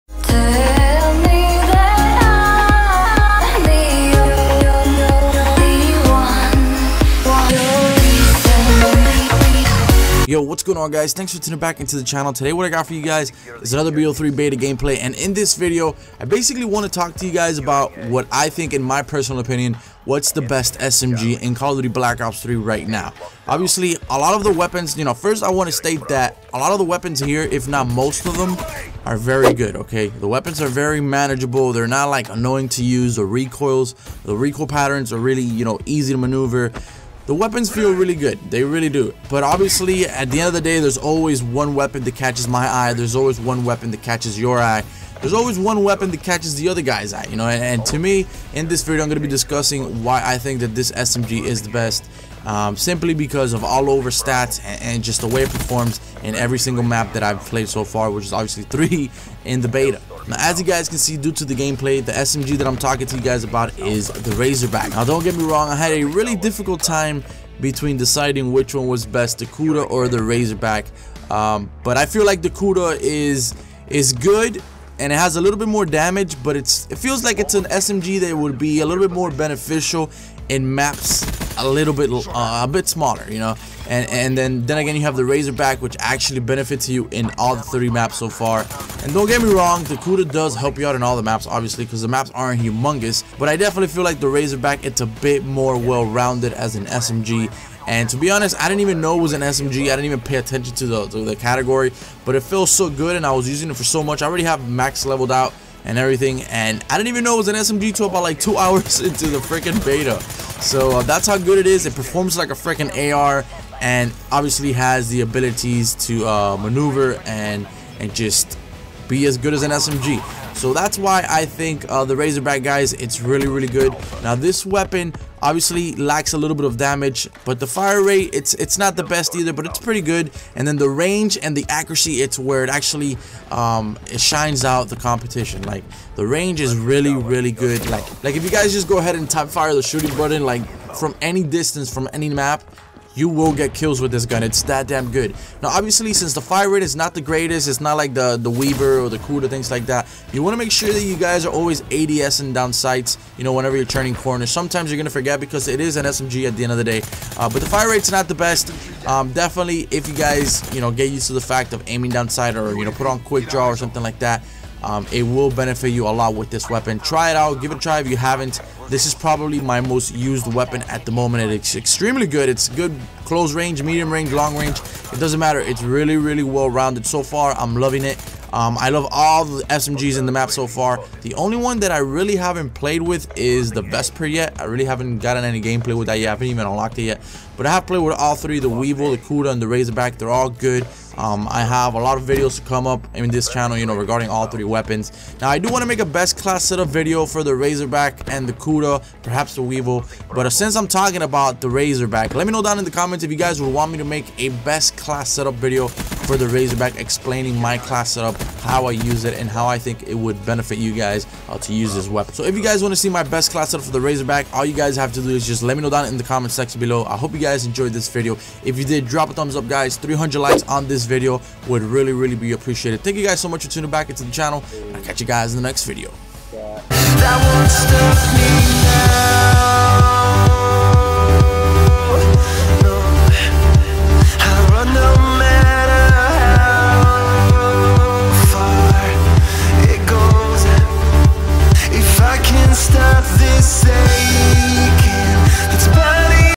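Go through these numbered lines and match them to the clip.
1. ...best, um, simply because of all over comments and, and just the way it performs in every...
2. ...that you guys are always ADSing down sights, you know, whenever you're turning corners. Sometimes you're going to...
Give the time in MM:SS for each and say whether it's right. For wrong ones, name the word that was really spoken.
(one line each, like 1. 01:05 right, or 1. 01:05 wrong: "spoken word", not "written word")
1. 00:51 wrong: "stats", not "comments"
2. 02:30 right.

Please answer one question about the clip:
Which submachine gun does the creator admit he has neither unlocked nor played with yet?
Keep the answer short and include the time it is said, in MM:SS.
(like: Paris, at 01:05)
Vesper, at 03:03.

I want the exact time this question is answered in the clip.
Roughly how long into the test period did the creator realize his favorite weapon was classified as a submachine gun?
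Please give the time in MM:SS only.
01:48.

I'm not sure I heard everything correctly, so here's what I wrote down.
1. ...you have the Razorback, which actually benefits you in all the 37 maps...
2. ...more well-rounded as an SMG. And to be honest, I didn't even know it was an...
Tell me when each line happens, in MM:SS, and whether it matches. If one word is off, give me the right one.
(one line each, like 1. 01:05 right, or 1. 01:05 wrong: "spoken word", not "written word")
1. 01:24 wrong: "30", not "37"
2. 01:35 right.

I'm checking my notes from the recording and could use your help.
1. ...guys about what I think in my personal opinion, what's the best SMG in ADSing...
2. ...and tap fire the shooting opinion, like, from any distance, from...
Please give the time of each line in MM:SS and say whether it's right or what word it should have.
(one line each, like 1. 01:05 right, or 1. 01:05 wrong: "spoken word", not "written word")
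1. 00:17 wrong: "Call", not "ADSing"
2. 02:19 wrong: "button", not "opinion".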